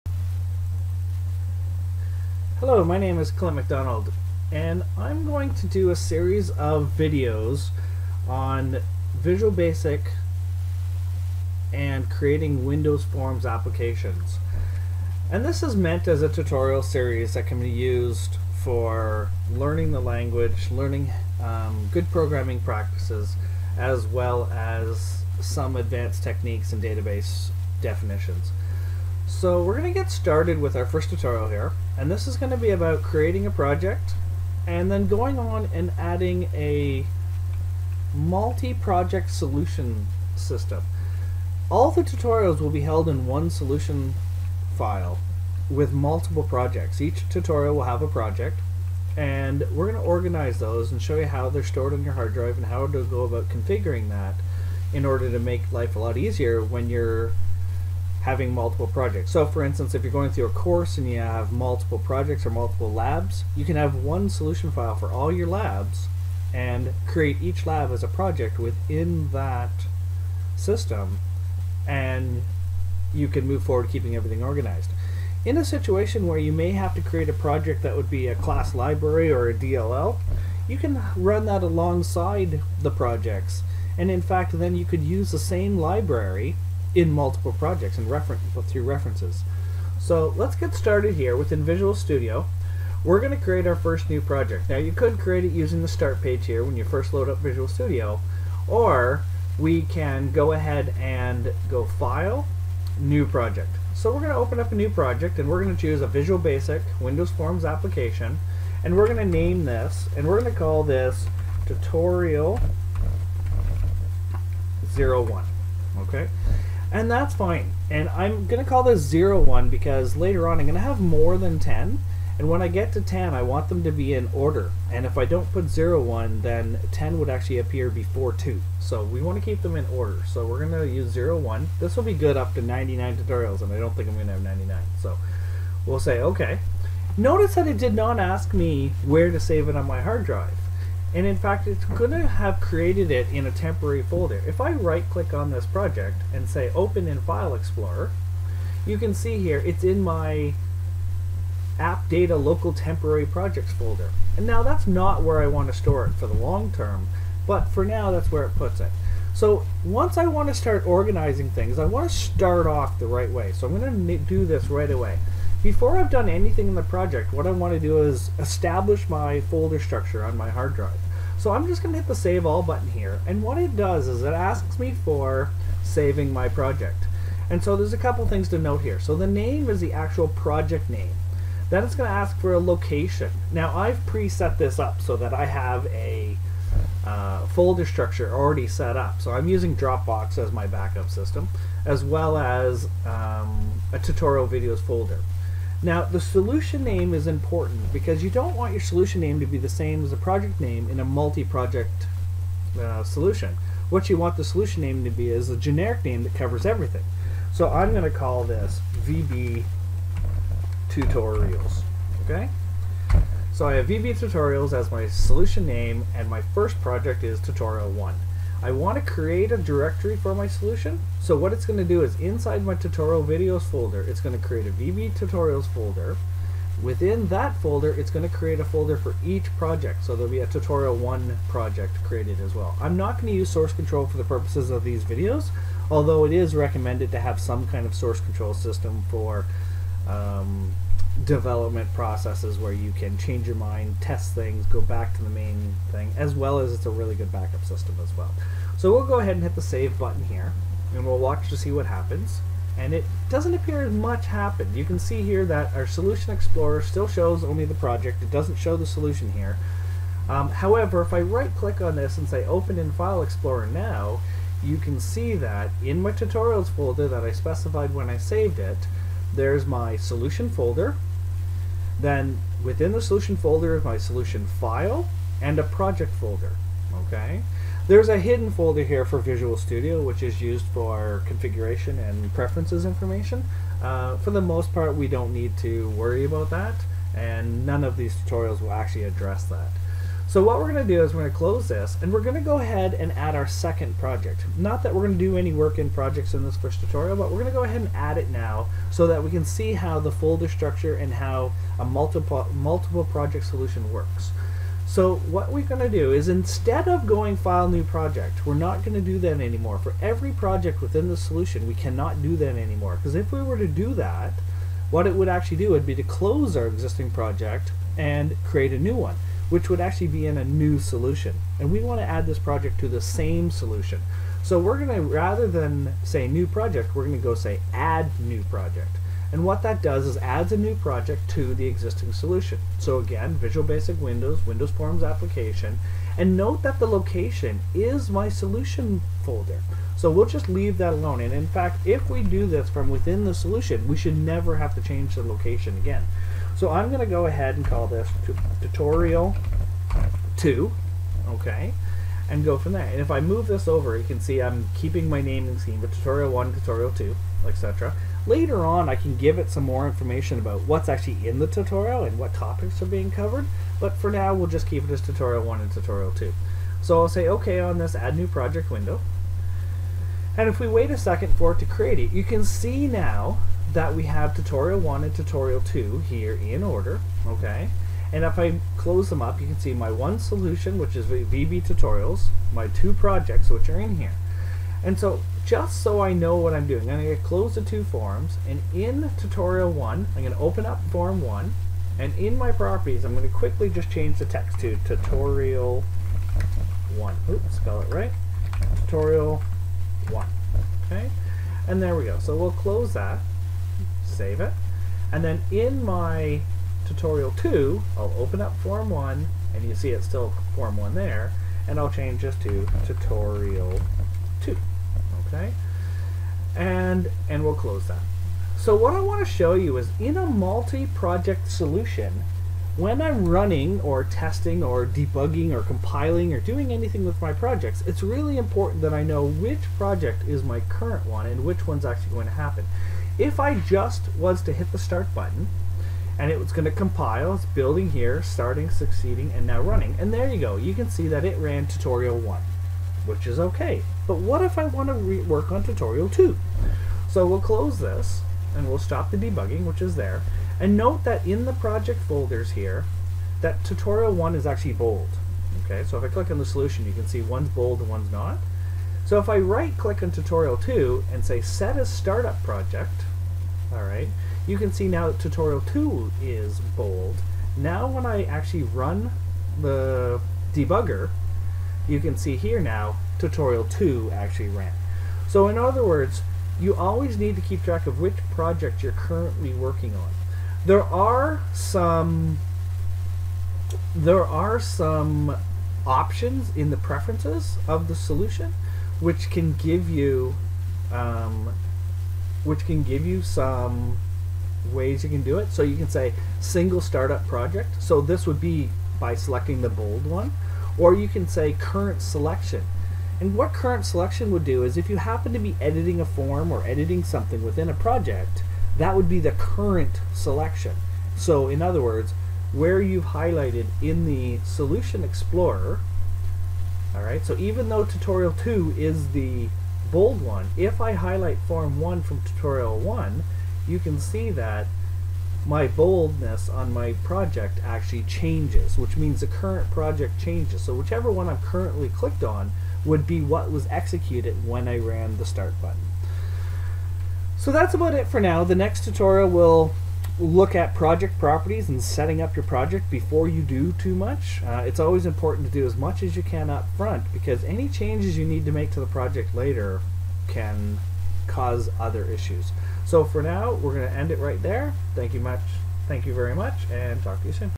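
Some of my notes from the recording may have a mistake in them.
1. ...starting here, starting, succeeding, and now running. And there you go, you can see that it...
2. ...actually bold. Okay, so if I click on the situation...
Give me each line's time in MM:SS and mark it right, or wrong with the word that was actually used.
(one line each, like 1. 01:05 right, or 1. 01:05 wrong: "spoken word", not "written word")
1. 07:17 wrong: "building", not "starting"
2. 07:34 wrong: "solution", not "situation".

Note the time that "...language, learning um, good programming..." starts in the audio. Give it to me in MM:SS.
00:19.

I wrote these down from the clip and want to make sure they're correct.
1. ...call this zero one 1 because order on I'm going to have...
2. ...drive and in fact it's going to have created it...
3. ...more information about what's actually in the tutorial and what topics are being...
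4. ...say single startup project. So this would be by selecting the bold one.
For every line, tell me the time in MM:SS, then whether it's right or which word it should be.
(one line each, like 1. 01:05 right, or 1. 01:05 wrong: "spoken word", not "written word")
1. 01:58 wrong: "later", not "order"
2. 02:20 right
3. 05:59 right
4. 08:15 right.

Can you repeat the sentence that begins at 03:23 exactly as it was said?
What you want the solution name to be is a generic name that covers everything.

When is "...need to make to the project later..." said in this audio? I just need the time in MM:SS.
09:08.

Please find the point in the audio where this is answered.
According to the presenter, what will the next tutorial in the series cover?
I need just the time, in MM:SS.
09:00.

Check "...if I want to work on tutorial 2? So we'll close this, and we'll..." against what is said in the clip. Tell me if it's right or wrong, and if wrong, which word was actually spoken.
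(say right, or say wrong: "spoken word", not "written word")
right.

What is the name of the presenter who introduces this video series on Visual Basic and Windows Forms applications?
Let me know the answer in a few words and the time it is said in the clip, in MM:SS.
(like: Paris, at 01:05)
Clint MacDonald, at 00:03.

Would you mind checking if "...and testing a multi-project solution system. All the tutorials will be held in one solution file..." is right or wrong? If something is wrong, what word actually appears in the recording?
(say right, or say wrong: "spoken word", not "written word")
wrong: "adding", not "testing".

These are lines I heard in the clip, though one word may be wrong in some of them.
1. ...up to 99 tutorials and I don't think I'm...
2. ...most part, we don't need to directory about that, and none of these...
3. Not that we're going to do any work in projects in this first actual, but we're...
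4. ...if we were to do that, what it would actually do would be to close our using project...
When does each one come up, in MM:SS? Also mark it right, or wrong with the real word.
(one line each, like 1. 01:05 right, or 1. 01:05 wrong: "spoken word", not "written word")
1. 02:12 right
2. 04:44 wrong: "worry", not "directory"
3. 04:54 wrong: "tutorial", not "actual"
4. 05:13 wrong: "existing", not "using".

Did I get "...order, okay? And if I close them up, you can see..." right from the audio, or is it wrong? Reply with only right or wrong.
right.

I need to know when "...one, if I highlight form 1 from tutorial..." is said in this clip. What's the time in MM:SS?
08:40.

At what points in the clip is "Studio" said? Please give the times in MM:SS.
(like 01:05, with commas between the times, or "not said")
01:31, 01:37, 04:39.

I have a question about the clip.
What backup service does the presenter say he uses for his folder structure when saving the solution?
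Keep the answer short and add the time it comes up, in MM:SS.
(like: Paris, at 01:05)
Dropbox, at 03:09.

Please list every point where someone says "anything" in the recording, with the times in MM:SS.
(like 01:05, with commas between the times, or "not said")
02:46, 07:06.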